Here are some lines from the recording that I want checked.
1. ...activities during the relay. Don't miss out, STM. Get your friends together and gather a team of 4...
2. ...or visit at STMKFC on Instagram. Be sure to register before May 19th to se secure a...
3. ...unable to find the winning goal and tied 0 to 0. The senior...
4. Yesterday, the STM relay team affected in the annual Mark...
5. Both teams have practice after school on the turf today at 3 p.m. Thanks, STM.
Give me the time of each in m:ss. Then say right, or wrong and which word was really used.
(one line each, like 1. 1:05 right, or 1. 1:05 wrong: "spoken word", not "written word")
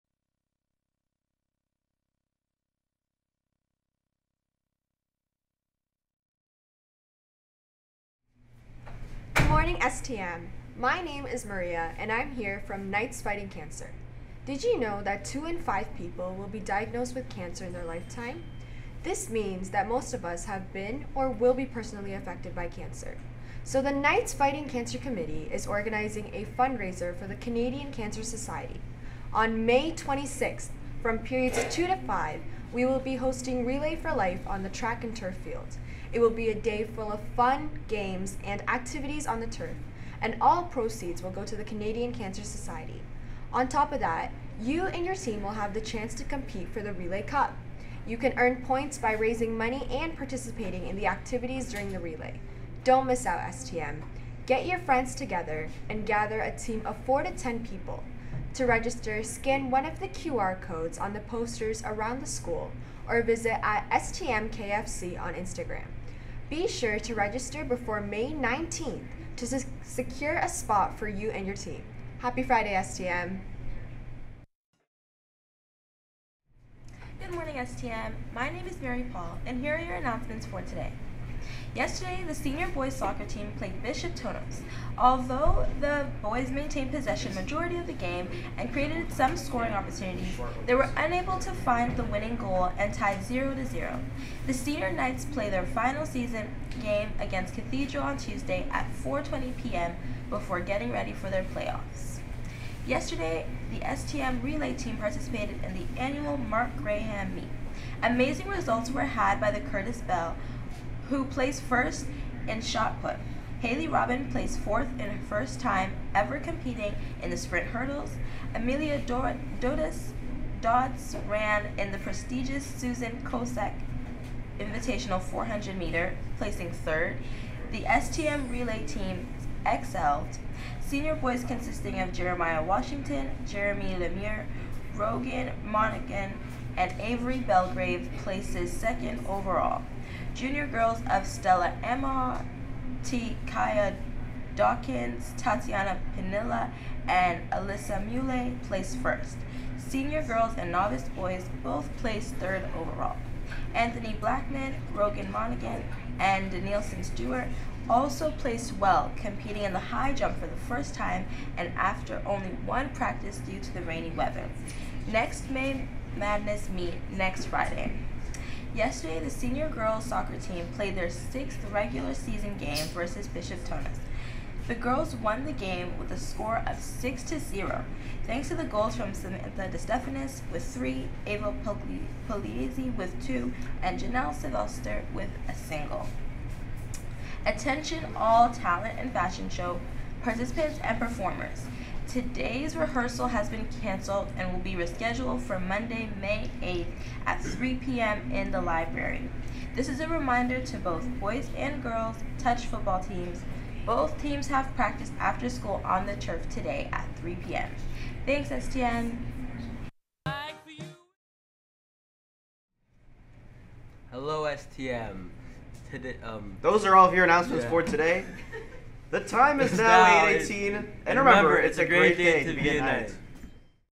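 1. 0:51 right
2. 1:03 right
3. 1:30 right
4. 1:42 wrong: "participated", not "affected"
5. 3:23 right.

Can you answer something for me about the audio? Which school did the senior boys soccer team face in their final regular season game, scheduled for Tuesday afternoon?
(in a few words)
Cathedral.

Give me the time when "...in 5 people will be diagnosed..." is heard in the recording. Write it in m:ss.
0:15.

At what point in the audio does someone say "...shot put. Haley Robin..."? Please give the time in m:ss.
1:52.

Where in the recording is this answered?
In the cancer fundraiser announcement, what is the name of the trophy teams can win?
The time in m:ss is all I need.
0:46.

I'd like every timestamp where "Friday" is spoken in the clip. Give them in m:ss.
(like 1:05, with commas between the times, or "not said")
1:12, 2:47.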